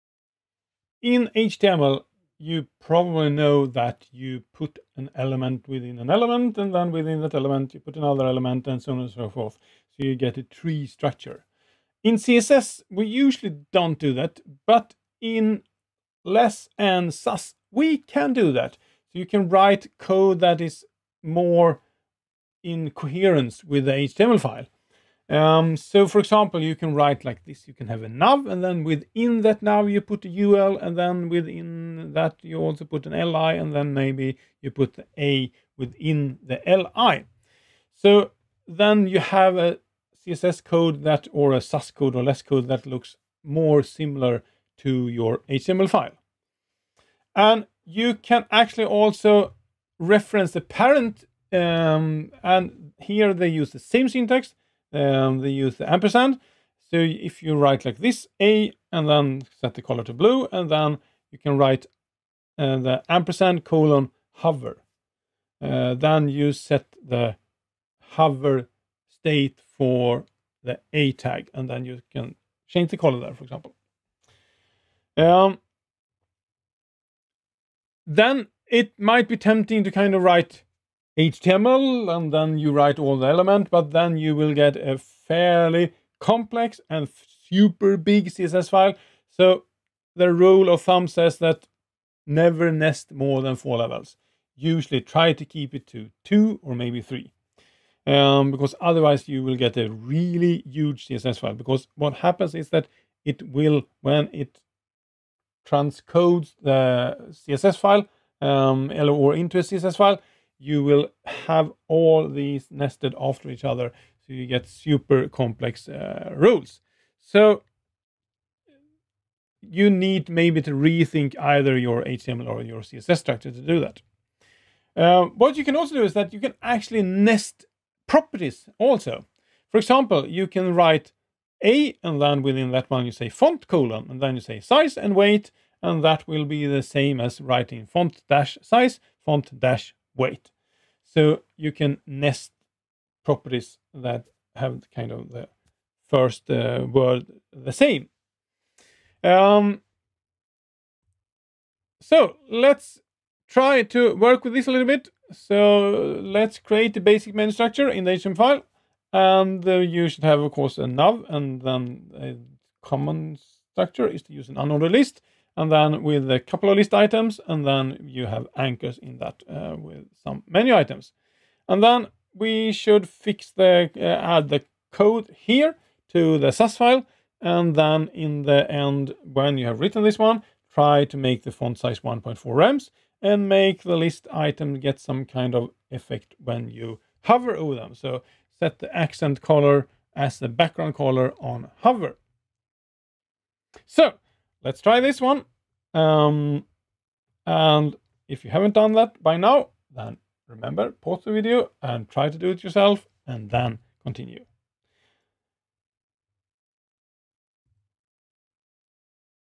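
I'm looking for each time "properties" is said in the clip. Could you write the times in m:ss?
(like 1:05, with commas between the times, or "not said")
2:08, 2:23.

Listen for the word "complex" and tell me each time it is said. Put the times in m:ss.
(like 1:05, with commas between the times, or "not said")
1:26, 1:55.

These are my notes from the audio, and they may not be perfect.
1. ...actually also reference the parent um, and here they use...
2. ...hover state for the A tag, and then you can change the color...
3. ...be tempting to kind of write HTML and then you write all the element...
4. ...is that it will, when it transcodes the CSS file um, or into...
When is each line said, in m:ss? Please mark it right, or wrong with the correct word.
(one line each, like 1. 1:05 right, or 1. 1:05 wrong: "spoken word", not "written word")
1. 0:48 right
2. 1:07 right
3. 1:19 right
4. 1:42 right.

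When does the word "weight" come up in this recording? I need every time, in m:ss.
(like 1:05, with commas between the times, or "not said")
2:15, 2:20.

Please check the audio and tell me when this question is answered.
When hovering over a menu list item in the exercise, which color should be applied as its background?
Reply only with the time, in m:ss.
3:08.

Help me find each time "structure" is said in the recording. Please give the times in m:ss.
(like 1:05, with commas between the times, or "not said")
0:10, 2:03, 2:37, 2:43.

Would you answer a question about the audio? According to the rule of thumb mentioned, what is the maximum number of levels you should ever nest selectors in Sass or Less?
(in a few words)
4.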